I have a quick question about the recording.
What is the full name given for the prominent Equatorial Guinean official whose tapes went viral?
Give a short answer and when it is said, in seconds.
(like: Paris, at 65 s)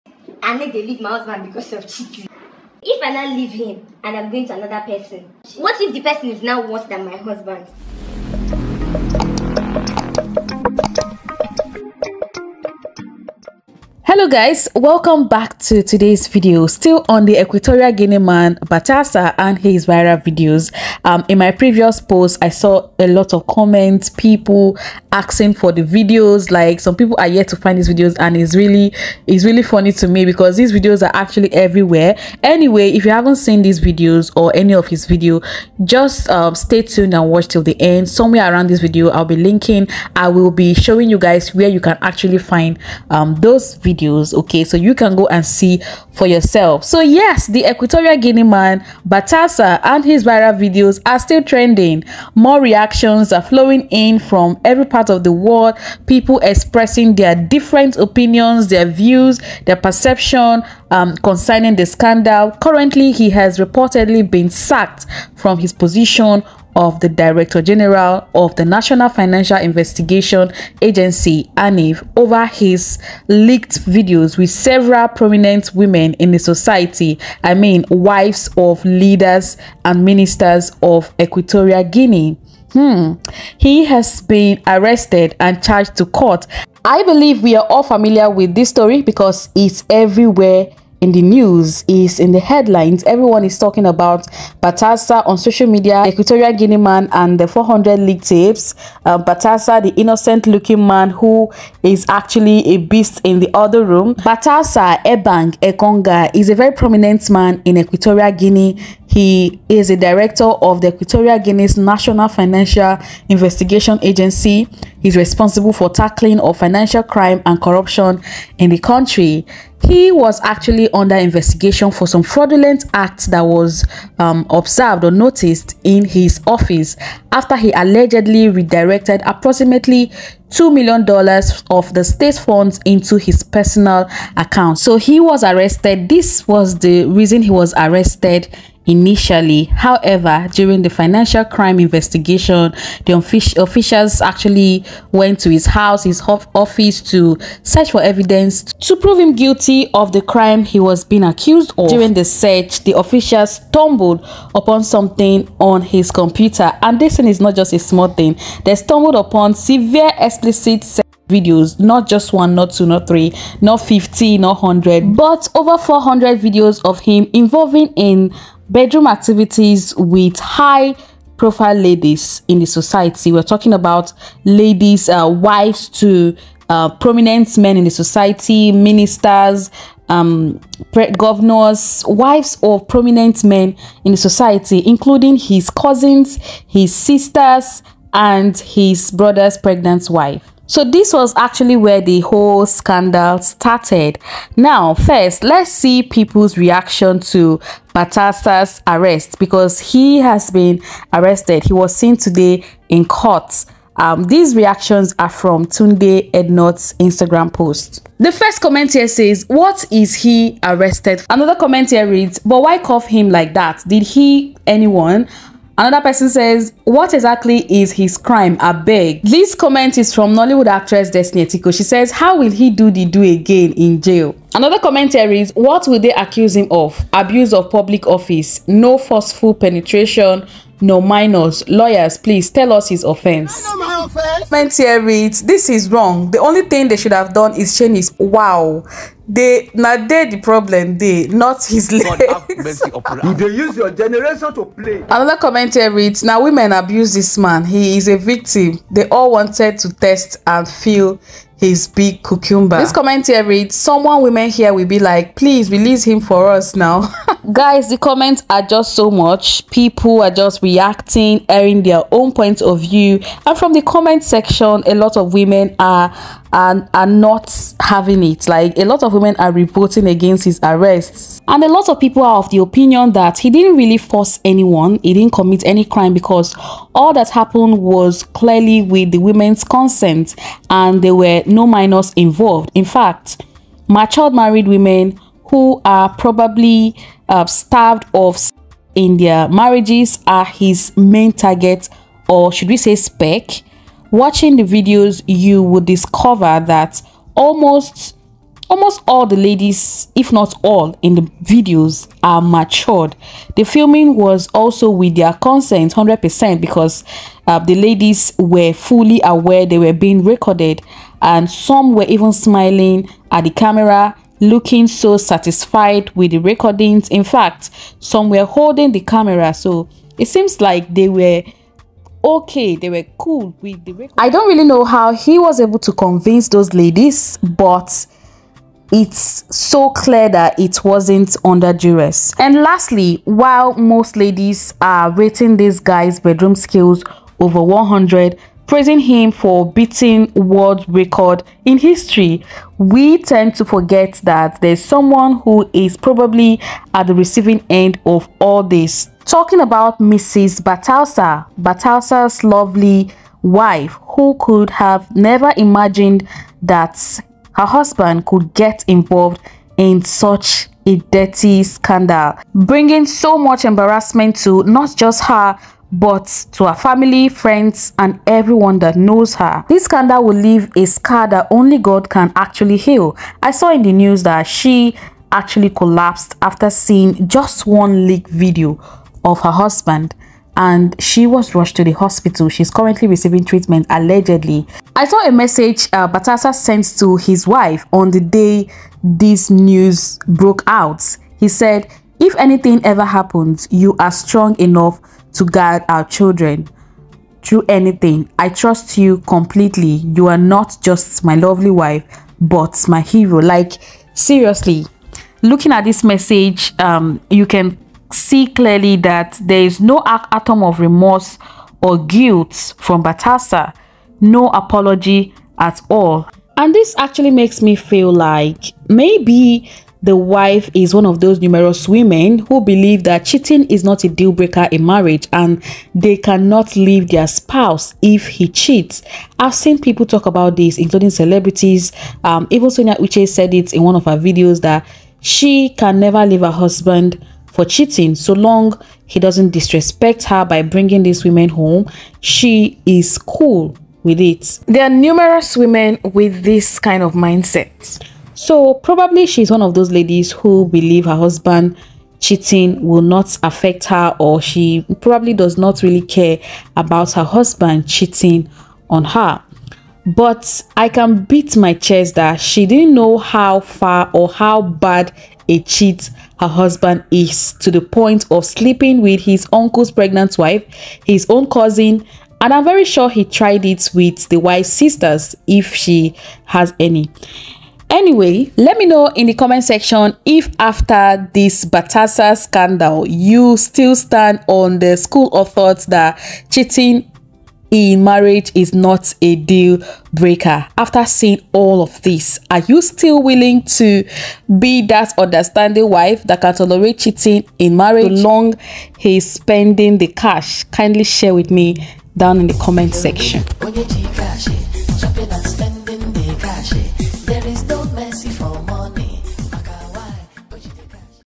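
Batasa Ebang Engonga, at 104 s.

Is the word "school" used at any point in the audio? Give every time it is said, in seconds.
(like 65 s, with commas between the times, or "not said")
484 s.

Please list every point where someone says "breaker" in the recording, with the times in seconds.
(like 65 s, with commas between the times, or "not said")
424 s, 490 s.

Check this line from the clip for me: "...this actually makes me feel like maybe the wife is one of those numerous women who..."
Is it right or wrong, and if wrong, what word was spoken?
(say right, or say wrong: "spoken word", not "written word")
right.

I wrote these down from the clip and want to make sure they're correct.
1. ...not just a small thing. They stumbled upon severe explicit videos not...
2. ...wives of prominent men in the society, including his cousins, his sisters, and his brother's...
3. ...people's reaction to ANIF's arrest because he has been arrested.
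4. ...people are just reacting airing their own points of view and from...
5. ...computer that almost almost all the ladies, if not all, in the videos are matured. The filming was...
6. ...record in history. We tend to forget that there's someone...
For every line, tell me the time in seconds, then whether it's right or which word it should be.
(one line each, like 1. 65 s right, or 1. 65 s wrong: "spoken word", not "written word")
1. 157 s right
2. 182 s right
3. 196 s wrong: "Batassa", not "ANIF"
4. 259 s right
5. 295 s wrong: "discover", not "computer"
6. 340 s right.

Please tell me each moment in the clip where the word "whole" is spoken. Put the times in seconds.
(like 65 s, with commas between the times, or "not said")
192 s.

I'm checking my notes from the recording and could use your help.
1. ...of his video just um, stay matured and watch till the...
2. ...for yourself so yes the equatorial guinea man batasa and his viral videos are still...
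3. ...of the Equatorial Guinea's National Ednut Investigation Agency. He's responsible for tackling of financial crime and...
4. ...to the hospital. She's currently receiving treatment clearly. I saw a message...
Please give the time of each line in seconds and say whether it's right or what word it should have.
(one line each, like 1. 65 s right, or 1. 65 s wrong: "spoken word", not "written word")
1. 34 s wrong: "tuned", not "matured"
2. 46 s right
3. 110 s wrong: "Financial", not "Ednut"
4. 381 s wrong: "allegedly", not "clearly".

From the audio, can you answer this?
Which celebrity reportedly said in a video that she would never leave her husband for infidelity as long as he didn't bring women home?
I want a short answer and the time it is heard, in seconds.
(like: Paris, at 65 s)
Sonia Uche, at 432 s.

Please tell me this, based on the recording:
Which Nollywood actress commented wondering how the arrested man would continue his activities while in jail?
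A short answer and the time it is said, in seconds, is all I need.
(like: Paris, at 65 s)
Destiny Etiko, at 221 s.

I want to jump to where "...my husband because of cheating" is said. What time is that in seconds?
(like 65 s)
0 s.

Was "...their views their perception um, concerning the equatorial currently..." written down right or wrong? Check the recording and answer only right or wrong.
wrong.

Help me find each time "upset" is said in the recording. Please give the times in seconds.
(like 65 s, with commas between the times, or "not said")
not said.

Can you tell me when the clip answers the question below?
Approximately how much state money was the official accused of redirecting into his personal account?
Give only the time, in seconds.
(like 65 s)
130 s.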